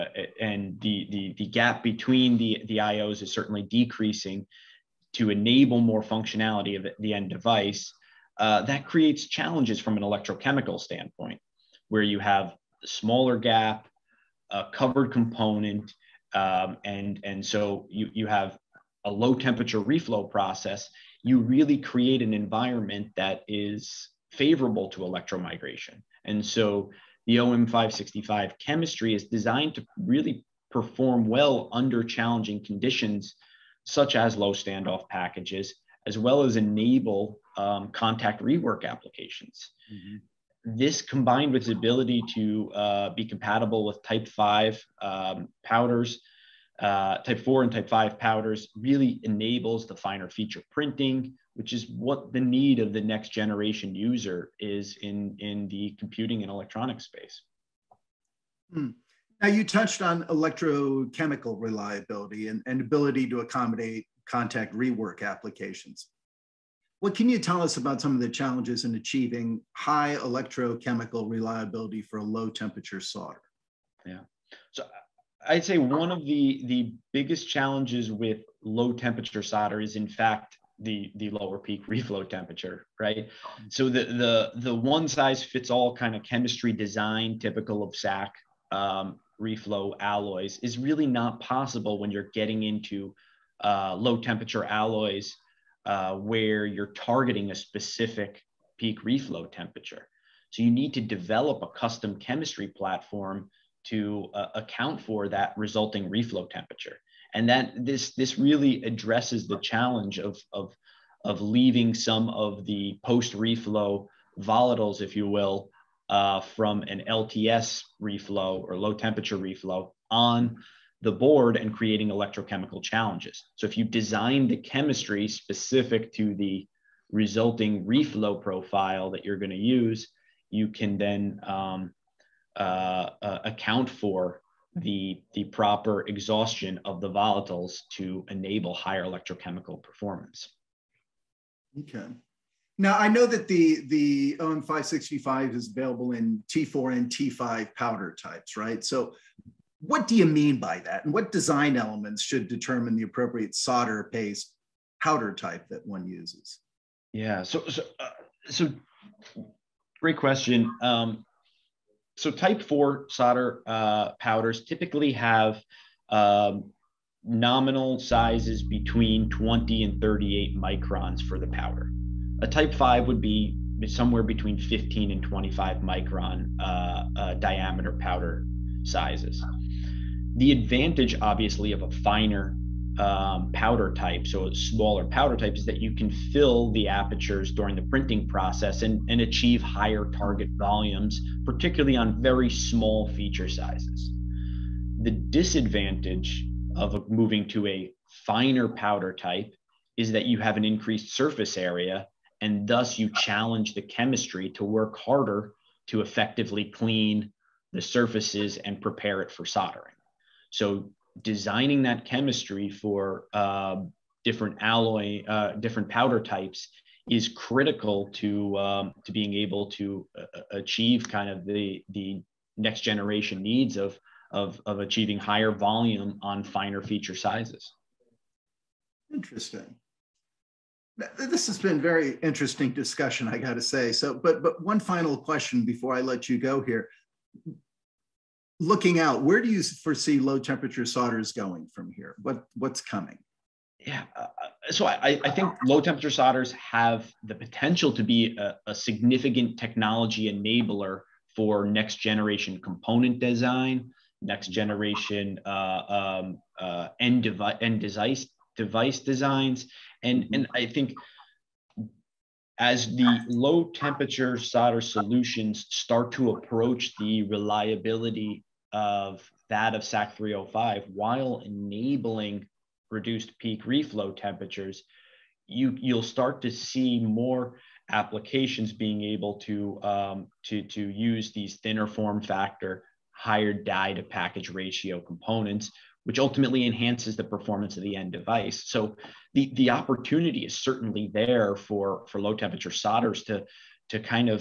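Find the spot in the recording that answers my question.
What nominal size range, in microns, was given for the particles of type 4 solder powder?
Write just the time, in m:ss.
2:49.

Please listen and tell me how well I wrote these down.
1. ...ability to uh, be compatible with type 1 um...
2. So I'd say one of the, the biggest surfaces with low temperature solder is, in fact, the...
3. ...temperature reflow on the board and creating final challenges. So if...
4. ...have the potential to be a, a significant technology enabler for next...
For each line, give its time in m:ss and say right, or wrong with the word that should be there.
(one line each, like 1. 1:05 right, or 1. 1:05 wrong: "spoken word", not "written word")
1. 0:41 wrong: "5", not "1"
2. 1:14 wrong: "challenges", not "surfaces"
3. 1:58 wrong: "electrochemical", not "final"
4. 4:06 right.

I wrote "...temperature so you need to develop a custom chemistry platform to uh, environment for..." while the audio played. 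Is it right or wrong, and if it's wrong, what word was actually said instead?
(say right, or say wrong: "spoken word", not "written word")
wrong: "account", not "environment".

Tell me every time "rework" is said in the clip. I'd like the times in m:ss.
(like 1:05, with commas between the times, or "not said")
0:38, 1:04.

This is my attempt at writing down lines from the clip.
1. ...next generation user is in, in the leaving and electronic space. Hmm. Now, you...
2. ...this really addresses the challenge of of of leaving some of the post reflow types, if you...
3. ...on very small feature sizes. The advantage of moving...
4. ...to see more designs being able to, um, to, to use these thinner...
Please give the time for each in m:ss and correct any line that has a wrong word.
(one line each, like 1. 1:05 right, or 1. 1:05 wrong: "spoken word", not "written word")
1. 0:53 wrong: "computing", not "leaving"
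2. 1:48 wrong: "volatiles", not "types"
3. 3:11 wrong: "disadvantage", not "advantage"
4. 4:36 wrong: "applications", not "designs".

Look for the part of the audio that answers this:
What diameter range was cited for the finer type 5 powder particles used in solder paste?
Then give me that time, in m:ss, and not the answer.
2:54.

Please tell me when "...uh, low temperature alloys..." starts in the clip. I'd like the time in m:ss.
1:33.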